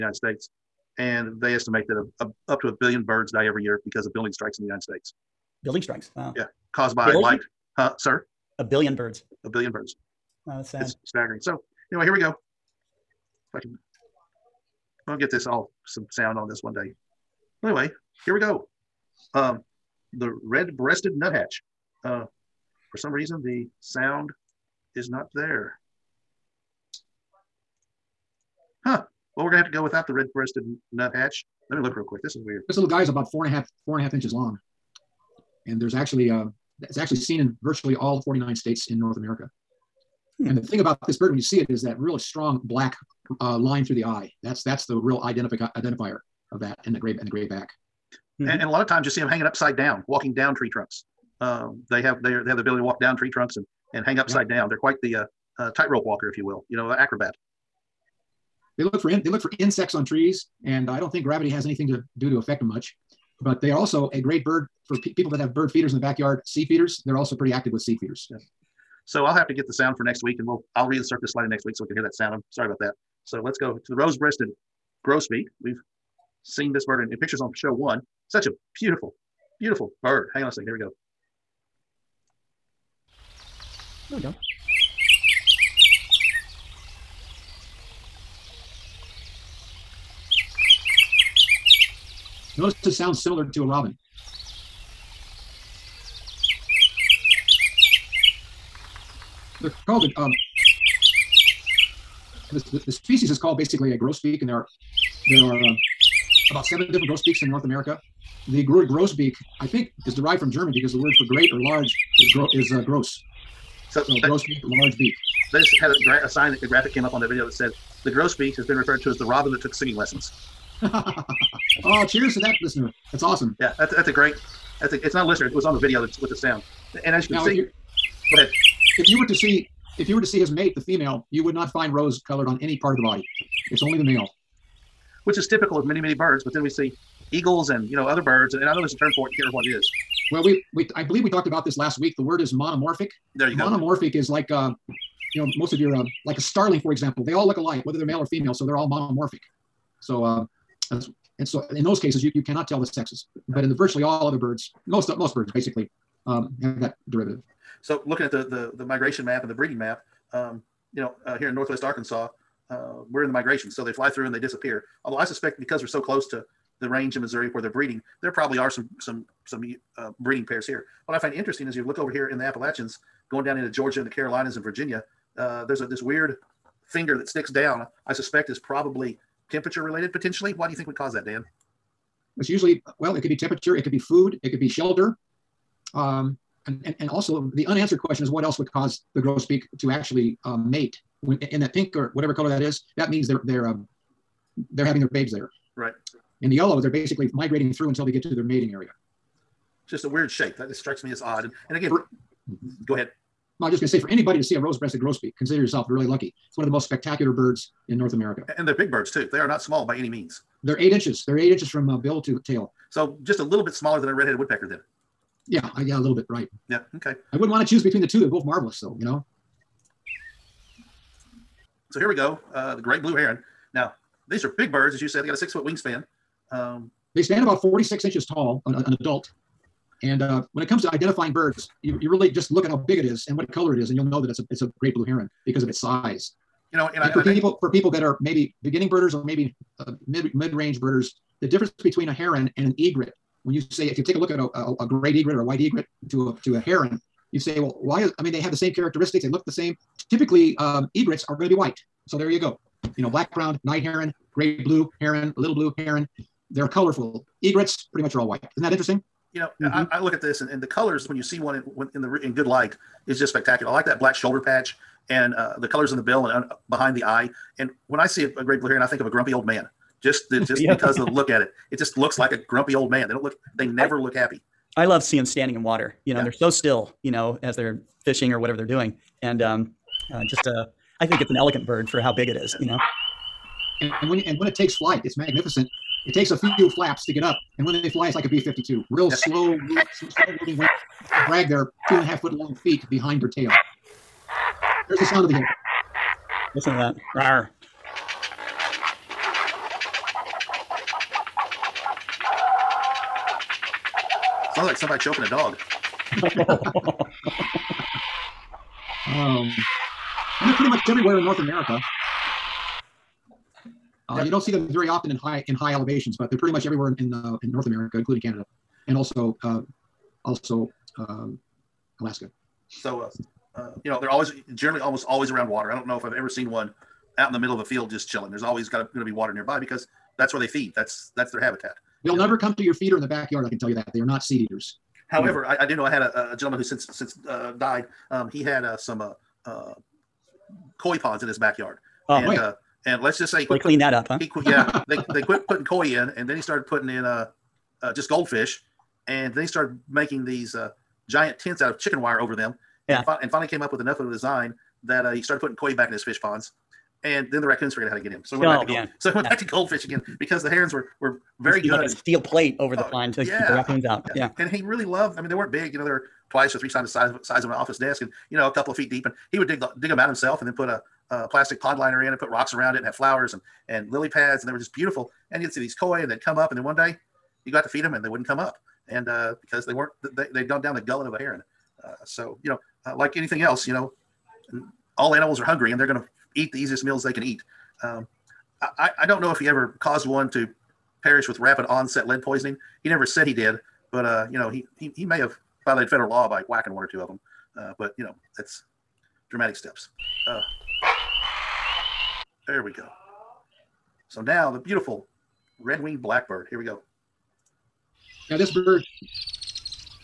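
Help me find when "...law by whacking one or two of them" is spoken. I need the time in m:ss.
6:36.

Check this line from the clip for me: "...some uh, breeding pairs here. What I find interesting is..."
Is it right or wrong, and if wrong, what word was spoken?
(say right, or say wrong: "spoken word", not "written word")
right.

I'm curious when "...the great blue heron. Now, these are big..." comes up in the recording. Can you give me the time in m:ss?
3:42.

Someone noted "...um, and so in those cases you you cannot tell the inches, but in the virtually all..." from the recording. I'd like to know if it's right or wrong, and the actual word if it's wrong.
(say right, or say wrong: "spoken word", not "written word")
wrong: "sexes", not "inches".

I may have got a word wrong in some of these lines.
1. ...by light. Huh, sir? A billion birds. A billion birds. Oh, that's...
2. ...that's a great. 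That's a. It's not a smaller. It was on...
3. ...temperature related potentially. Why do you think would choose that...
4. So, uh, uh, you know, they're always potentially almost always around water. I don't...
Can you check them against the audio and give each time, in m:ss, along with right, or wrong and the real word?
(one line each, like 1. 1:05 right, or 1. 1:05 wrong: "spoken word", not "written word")
1. 0:06 right
2. 2:03 wrong: "listener", not "smaller"
3. 2:59 wrong: "cause", not "choose"
4. 5:22 wrong: "generally", not "potentially".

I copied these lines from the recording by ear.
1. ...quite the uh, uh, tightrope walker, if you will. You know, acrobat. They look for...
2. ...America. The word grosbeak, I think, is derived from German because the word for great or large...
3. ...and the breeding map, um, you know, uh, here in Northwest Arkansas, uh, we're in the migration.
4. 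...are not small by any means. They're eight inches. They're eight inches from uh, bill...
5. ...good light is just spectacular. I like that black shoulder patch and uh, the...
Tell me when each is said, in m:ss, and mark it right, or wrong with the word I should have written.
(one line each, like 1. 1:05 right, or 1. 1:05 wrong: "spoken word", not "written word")
1. 0:54 right
2. 1:47 right
3. 2:39 right
4. 3:29 right
5. 4:22 right.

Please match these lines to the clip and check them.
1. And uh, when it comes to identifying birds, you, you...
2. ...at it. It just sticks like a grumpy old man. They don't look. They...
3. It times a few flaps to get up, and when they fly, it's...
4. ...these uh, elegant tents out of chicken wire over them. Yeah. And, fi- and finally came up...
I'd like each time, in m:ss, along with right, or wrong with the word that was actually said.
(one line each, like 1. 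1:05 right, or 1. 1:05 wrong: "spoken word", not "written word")
1. 3:50 right
2. 4:31 wrong: "looks", not "sticks"
3. 4:46 wrong: "takes", not "times"
4. 5:50 wrong: "giant", not "elegant".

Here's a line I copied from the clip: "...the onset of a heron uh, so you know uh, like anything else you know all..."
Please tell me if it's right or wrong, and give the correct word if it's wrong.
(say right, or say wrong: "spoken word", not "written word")
wrong: "gullet", not "onset".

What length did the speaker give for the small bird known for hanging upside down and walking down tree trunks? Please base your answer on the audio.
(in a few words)
4.5 inches.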